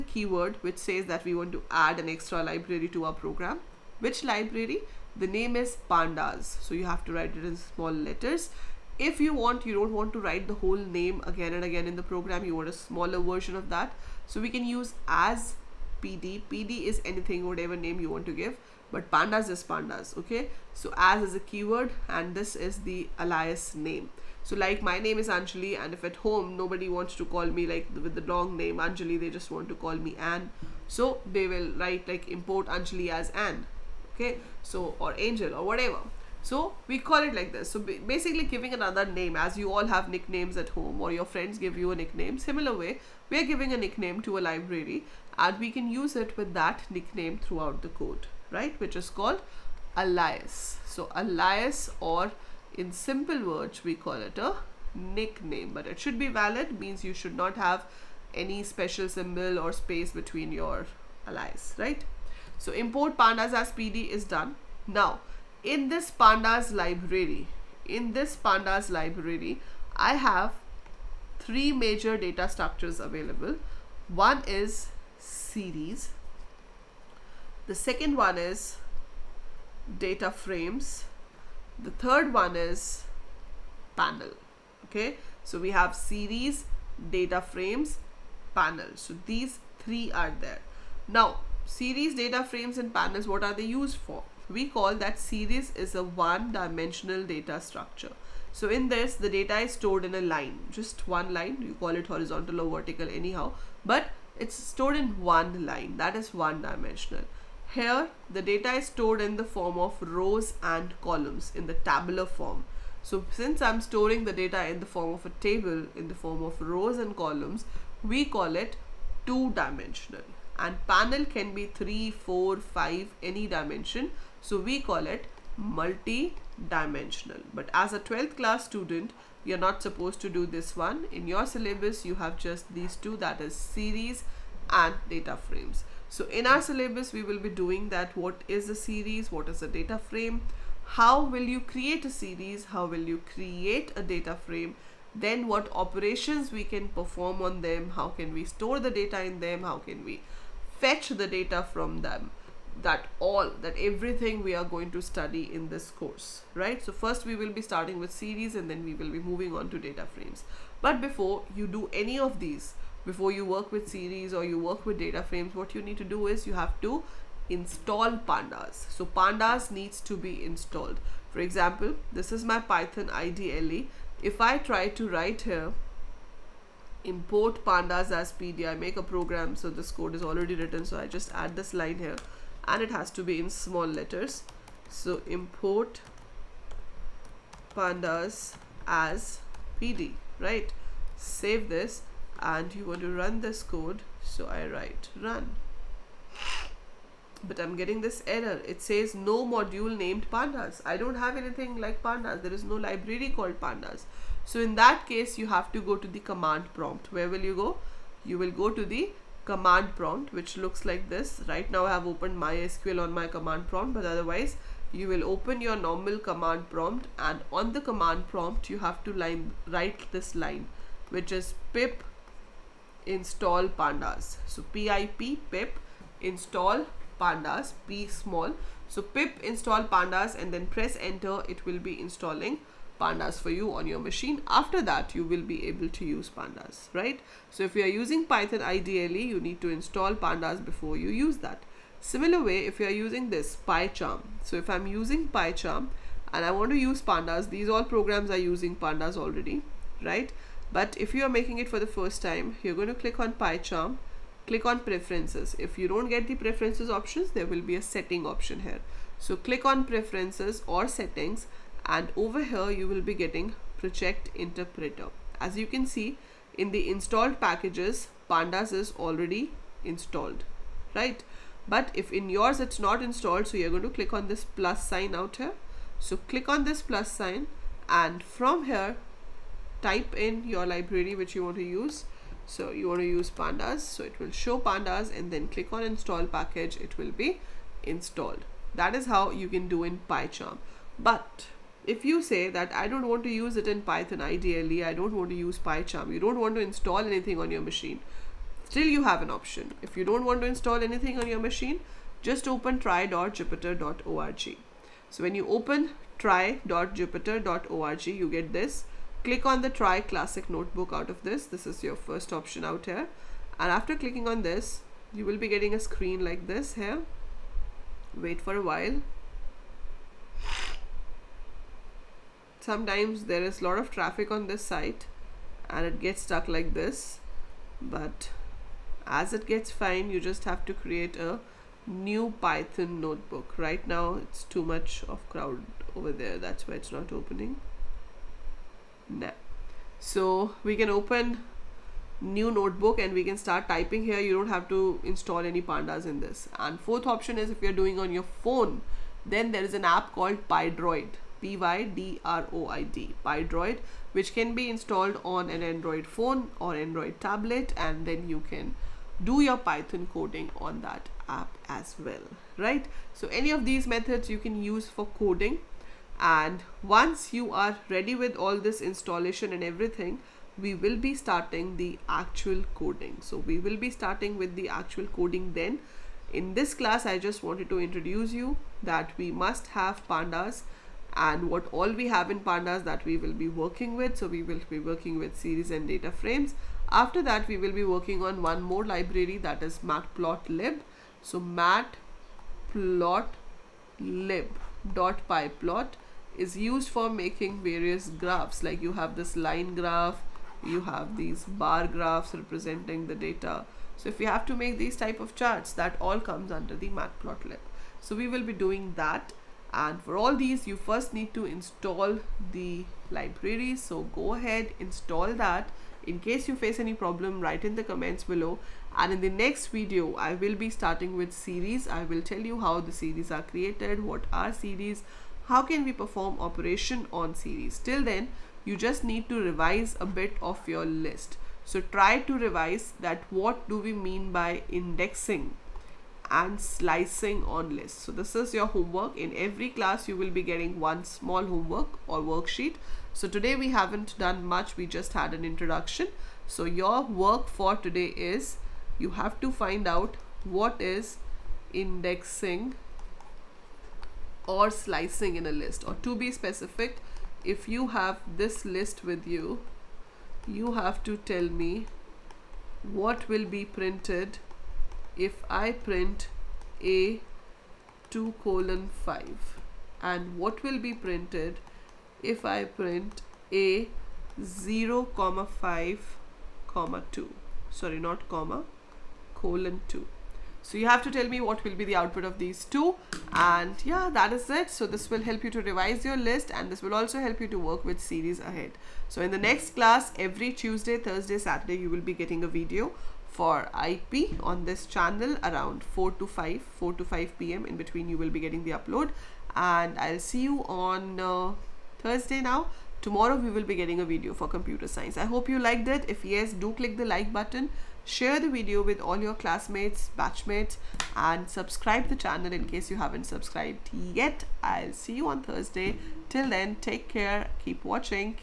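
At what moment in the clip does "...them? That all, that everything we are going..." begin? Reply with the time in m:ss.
2:32.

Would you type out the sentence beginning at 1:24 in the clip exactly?
Okay, so we have series, data frames, panel.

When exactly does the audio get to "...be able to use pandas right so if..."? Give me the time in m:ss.
3:55.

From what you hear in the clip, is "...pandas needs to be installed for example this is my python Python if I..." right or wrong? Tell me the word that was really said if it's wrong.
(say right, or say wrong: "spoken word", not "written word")
wrong: "IDLE", not "Python".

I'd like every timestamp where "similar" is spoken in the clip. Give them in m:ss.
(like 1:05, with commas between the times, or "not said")
0:42, 4:01.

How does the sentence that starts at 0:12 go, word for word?
You want a smaller version of that.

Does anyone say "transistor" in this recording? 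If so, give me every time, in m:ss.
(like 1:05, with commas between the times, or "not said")
not said.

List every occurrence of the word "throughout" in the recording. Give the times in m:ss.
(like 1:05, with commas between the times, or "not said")
0:47.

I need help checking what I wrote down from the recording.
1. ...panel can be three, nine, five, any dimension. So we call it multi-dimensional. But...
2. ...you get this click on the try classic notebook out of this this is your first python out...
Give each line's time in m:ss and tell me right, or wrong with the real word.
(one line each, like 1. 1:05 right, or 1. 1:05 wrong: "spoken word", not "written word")
1. 2:00 wrong: "four", not "nine"
2. 5:08 wrong: "option", not "python".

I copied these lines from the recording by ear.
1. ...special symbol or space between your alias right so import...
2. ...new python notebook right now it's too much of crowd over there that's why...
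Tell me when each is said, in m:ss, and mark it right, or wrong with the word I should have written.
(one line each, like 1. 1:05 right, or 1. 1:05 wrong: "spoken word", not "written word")
1. 0:58 right
2. 5:31 right.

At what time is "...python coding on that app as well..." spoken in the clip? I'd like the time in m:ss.
5:59.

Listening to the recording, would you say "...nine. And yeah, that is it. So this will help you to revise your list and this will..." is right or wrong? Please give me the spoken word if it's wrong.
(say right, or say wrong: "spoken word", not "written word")
wrong: "two", not "nine".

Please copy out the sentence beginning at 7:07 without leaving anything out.
Till then, you just need to revise a bit of your list.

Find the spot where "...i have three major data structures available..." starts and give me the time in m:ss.
1:09.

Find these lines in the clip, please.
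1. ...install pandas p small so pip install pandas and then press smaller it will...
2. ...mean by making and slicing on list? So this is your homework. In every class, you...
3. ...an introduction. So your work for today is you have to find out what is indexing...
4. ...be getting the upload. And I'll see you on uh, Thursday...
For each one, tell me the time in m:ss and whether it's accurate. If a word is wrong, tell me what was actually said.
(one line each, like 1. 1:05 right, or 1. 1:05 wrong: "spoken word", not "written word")
1. 3:46 wrong: "enter", not "smaller"
2. 7:13 wrong: "indexing", not "making"
3. 7:25 right
4. 8:18 right.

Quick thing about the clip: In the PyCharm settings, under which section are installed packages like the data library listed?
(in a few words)
project interpreter.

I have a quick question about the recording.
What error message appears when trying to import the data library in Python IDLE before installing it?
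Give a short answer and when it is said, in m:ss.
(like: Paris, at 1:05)
no module named pandas, at 3:19.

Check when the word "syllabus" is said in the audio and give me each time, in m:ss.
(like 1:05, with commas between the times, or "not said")
2:11, 2:16.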